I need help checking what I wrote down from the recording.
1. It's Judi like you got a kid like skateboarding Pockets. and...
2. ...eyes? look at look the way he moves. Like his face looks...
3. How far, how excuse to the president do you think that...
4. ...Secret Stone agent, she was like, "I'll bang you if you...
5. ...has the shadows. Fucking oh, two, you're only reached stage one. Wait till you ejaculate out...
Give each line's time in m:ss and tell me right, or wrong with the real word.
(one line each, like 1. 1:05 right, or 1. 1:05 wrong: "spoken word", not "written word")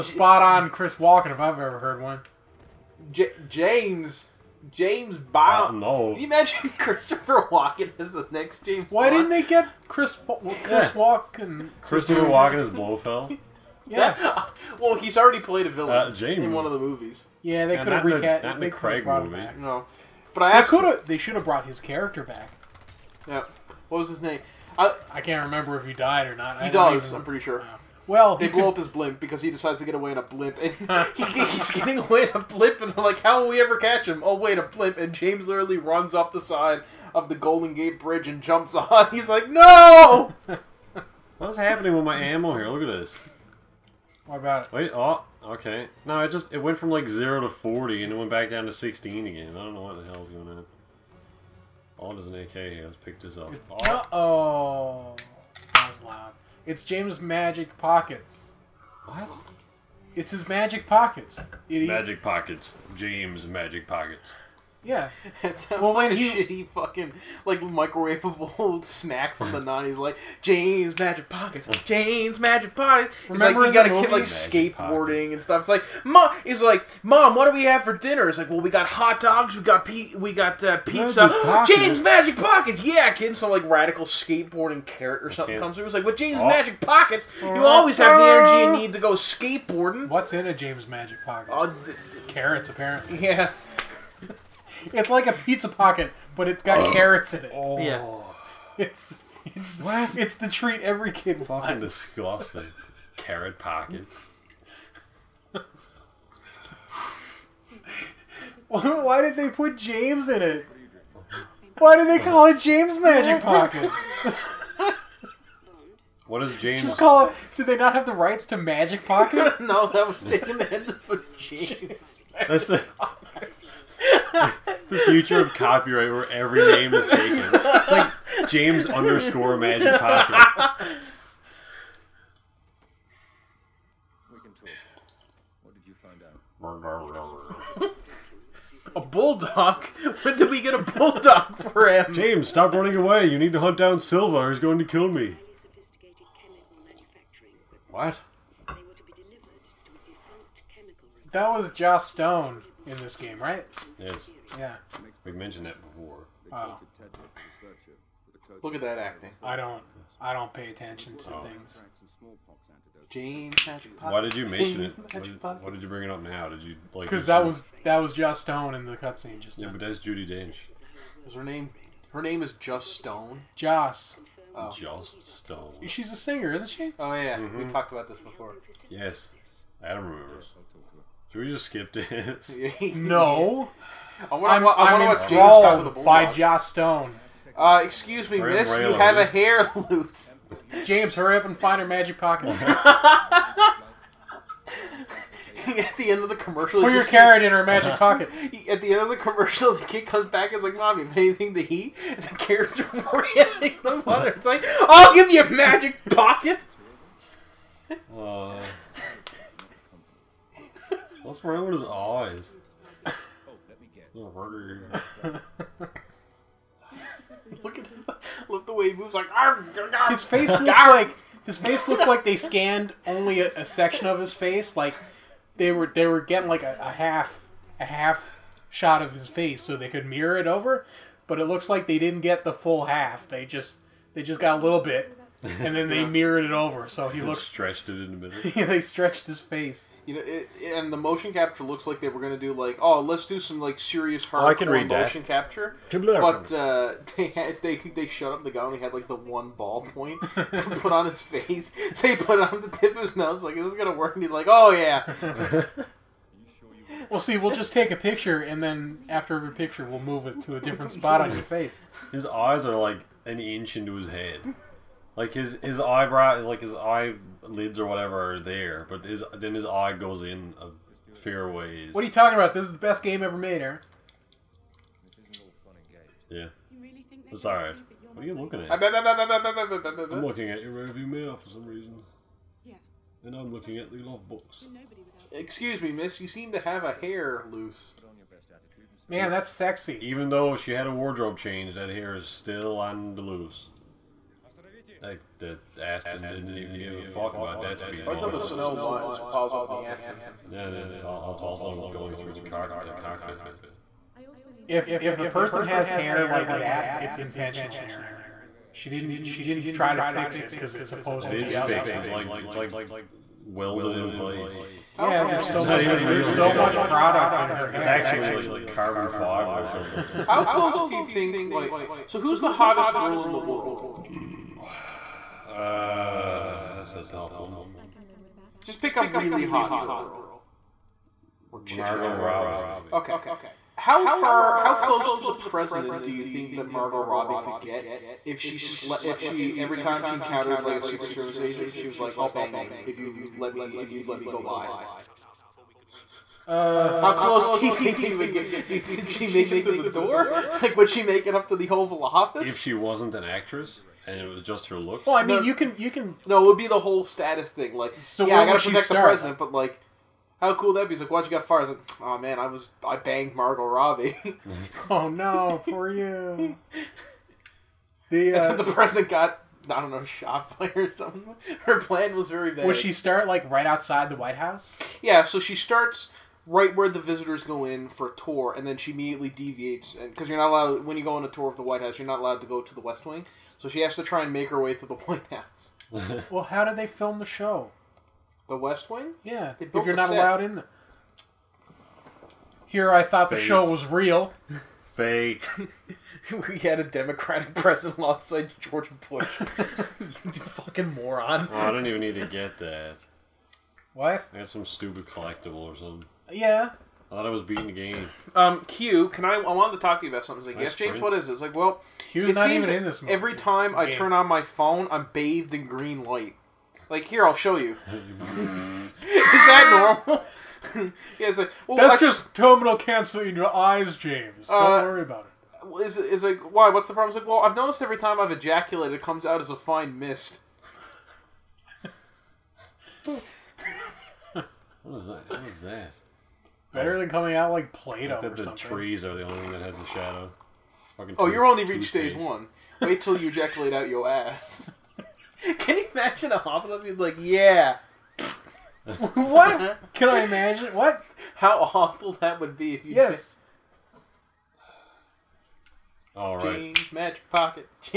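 1. 1:13 wrong: "Remember", not "Judi"
2. 3:31 right
3. 5:33 wrong: "close", not "excuse"
4. 5:40 wrong: "Service", not "Stone"
5. 7:19 right.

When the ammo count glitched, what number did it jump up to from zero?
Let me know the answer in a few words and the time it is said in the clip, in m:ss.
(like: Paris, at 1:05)
40, at 0:47.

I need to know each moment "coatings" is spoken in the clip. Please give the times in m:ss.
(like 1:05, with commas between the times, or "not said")
not said.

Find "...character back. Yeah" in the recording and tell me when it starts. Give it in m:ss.
0:21.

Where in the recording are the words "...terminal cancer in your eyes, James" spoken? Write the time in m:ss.
7:02.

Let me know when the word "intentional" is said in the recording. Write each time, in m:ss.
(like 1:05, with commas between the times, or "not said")
5:07.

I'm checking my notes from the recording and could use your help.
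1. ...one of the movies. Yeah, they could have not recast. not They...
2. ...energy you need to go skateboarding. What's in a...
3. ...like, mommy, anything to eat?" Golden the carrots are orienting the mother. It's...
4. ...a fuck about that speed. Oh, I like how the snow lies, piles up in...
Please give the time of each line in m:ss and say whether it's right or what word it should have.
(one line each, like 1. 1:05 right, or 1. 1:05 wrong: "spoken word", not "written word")
1. 0:16 right
2. 1:28 right
3. 3:20 wrong: "And", not "Golden"
4. 4:56 right.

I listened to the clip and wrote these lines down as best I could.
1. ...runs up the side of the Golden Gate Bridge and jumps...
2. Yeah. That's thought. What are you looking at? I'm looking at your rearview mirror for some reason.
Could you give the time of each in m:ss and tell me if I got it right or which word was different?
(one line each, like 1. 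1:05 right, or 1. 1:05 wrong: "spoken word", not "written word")
1. 0:35 right
2. 4:36 wrong: "alright", not "thought".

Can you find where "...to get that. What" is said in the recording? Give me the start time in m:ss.
6:42.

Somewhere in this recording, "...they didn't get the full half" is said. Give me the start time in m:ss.
3:51.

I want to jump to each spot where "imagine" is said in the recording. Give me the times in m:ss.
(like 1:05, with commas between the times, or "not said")
0:06, 7:25, 7:30.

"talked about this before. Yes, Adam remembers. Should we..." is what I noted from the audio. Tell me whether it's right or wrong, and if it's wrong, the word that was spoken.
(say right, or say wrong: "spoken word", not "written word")
right.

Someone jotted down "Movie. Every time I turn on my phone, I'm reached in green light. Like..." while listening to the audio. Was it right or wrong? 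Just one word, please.
wrong.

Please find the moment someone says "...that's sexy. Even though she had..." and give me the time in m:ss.
4:49.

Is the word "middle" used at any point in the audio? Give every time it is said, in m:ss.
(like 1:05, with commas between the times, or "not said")
3:58.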